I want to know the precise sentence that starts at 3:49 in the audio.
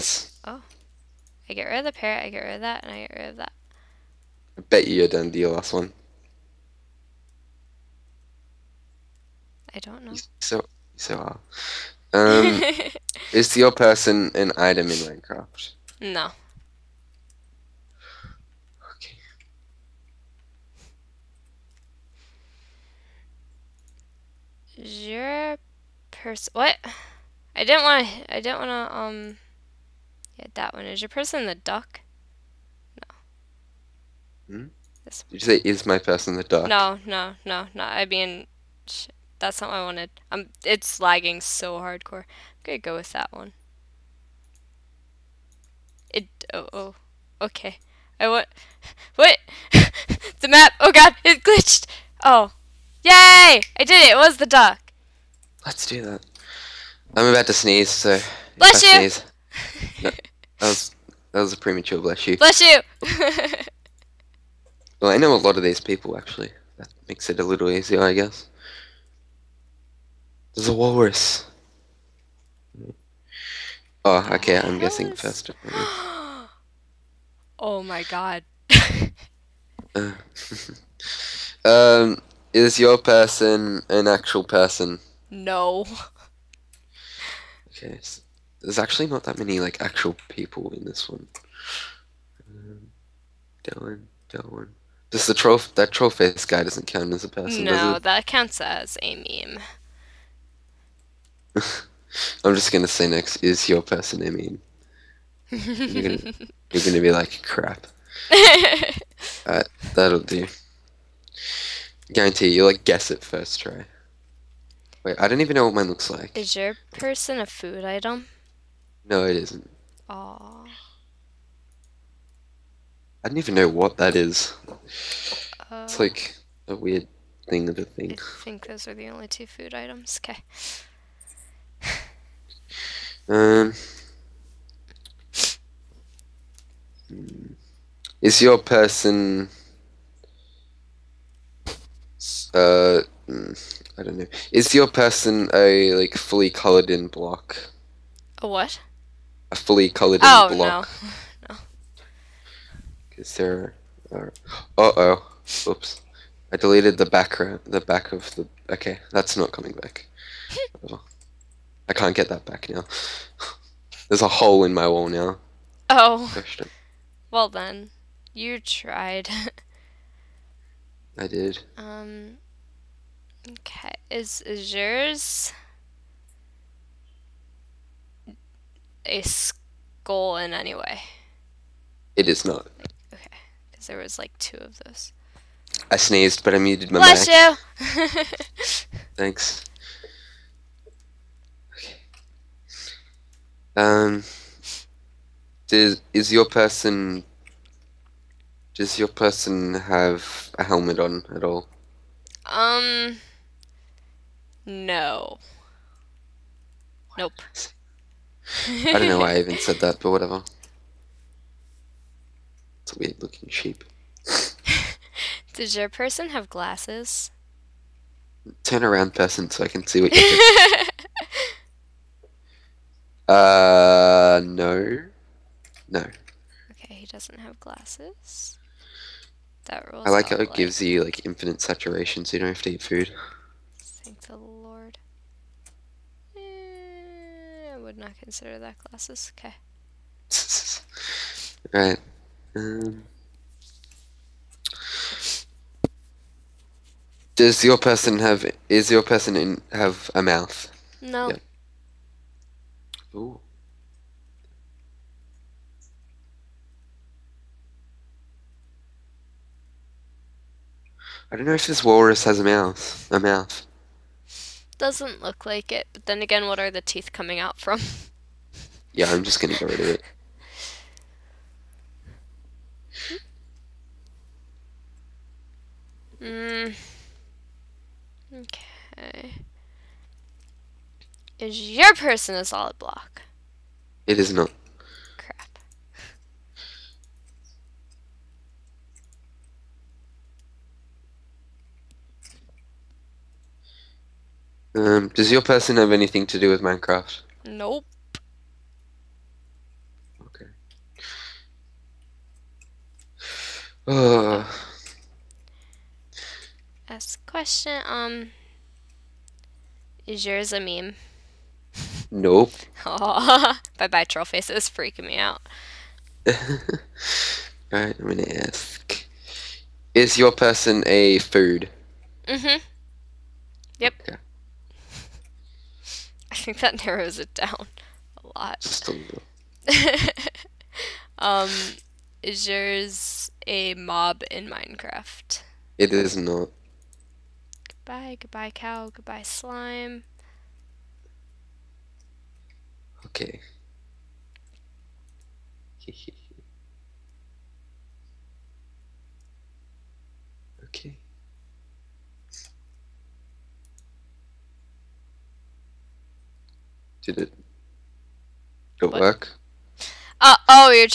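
That rules I like how it like...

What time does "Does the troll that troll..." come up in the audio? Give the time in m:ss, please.
1:35.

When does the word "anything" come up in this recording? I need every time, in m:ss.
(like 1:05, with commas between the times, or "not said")
4:55.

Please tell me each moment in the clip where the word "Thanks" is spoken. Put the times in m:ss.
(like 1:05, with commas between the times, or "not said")
3:09, 3:53.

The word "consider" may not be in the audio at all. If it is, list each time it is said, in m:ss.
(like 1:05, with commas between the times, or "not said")
3:58.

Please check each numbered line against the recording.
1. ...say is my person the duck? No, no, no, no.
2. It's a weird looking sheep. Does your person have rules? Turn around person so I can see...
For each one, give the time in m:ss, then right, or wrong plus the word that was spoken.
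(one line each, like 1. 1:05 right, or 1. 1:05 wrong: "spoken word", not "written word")
1. 0:35 right
2. 3:32 wrong: "glasses", not "rules".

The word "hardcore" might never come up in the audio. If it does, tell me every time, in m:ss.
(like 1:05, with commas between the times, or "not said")
0:41.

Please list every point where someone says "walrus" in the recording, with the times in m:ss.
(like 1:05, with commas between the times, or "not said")
1:10, 4:21.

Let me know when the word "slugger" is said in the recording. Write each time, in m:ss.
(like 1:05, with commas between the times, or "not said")
not said.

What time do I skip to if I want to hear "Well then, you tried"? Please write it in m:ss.
2:47.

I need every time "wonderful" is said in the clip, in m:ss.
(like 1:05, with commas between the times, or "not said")
not said.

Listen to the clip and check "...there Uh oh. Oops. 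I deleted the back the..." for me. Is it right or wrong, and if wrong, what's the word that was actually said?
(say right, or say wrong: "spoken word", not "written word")
right.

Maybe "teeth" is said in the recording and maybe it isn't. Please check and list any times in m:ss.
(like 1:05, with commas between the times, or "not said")
4:26.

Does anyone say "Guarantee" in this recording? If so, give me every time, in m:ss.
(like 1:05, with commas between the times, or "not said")
1:52.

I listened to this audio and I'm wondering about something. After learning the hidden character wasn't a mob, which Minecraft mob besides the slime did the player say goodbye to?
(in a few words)
cow.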